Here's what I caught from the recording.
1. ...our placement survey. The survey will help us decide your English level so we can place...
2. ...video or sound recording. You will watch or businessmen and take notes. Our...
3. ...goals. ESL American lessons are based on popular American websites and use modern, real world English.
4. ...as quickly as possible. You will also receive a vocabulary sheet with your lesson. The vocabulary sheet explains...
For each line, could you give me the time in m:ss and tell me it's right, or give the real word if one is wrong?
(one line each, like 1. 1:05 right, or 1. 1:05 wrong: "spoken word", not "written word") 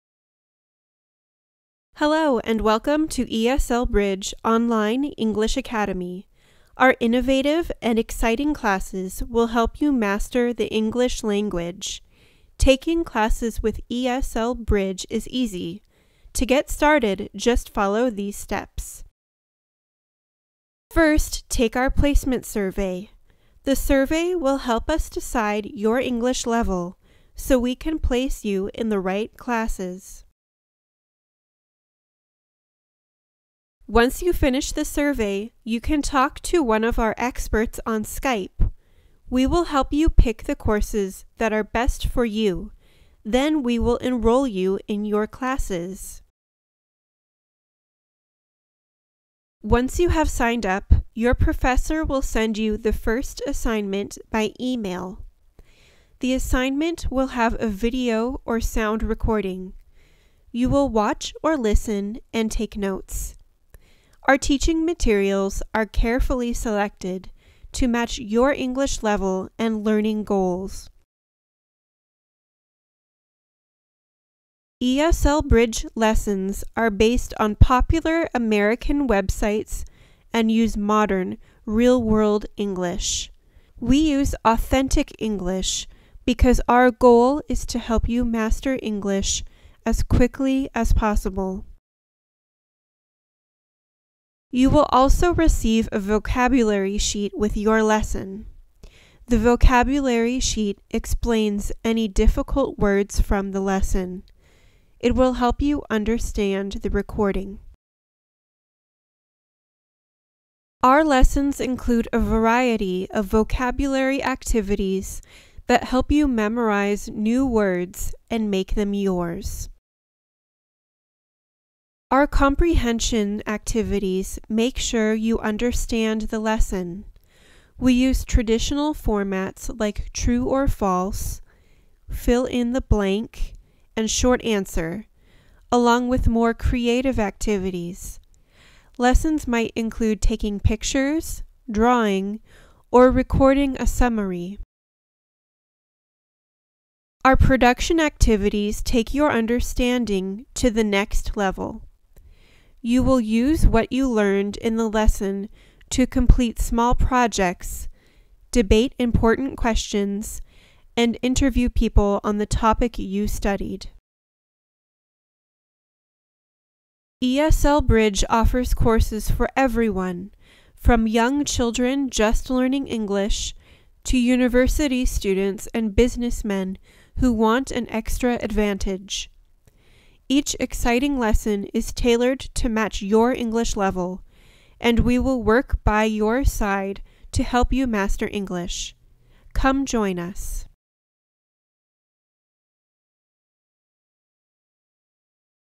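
1. 0:21 right
2. 0:57 wrong: "listen", not "businessmen"
3. 1:10 wrong: "Bridge", not "American"
4. 1:29 right.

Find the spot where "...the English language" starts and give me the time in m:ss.
0:10.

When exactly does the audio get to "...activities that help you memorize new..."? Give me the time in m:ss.
1:54.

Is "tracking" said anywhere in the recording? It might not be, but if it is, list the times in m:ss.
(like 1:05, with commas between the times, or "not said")
not said.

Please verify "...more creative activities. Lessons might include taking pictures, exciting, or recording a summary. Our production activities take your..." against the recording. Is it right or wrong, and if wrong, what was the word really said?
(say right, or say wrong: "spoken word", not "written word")
wrong: "drawing", not "exciting".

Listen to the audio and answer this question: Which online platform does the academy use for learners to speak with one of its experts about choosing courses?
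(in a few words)
Skype.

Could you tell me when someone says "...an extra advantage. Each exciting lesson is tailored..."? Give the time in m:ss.
2:57.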